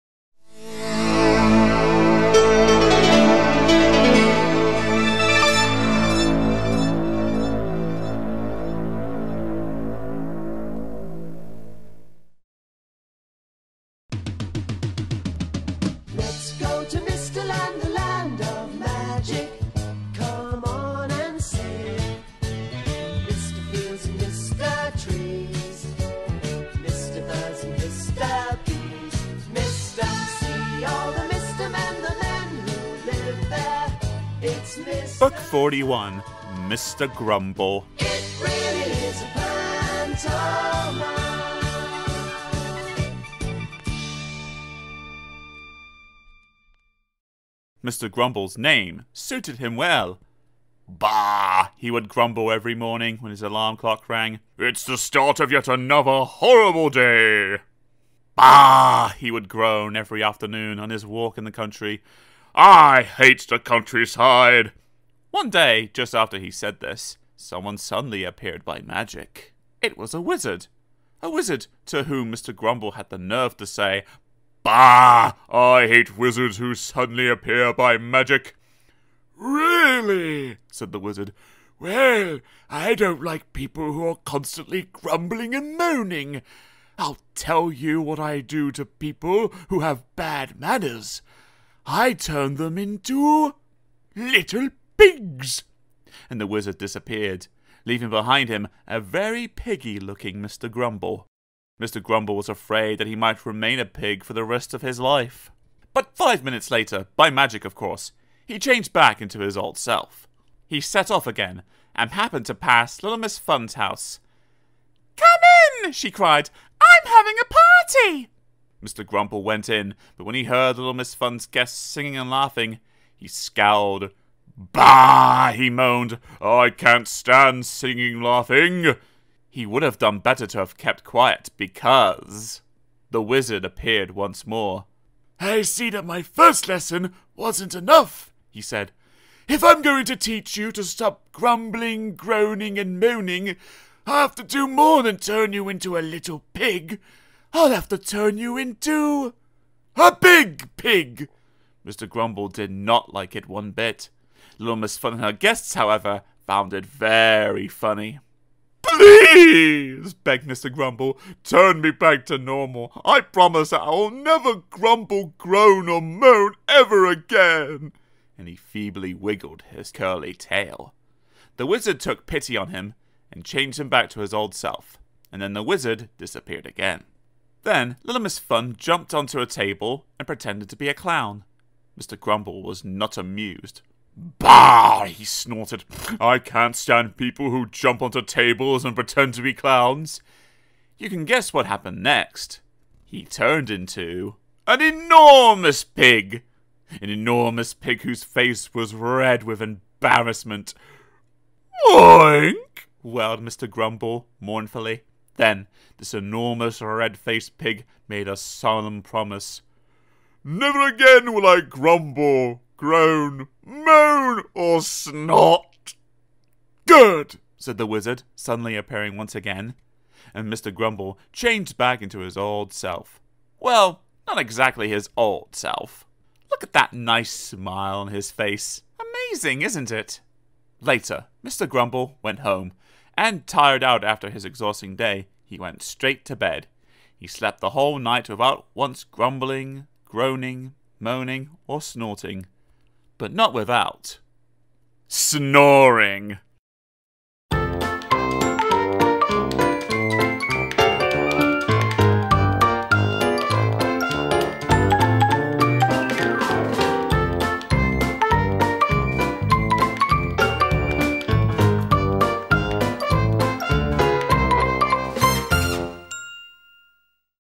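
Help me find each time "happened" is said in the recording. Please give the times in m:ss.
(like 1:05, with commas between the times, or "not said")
1:52, 3:11.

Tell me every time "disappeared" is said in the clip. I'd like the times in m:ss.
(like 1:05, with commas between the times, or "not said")
1:36, 2:56.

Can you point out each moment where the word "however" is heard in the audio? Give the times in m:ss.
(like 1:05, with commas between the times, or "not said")
2:35.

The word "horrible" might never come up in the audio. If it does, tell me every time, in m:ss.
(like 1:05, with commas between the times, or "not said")
0:56.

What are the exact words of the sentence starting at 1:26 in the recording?
I'll tell you what I do to people who have bad manners.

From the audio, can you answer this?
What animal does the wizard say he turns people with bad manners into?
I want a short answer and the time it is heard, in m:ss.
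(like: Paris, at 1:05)
little pigs, at 1:34.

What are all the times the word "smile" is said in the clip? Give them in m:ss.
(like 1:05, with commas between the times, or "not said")
3:47.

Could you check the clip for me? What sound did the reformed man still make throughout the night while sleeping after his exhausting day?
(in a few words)
snoring.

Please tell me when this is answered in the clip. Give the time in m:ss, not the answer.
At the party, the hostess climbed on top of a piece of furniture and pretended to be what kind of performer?
3:00.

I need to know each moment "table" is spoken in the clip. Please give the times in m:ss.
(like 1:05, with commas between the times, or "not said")
2:59, 3:08.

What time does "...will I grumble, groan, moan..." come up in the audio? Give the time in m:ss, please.
3:31.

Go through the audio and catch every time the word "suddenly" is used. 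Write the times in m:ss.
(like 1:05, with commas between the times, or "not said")
1:07, 1:16, 3:38.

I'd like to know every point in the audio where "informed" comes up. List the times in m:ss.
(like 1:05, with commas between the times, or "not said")
not said.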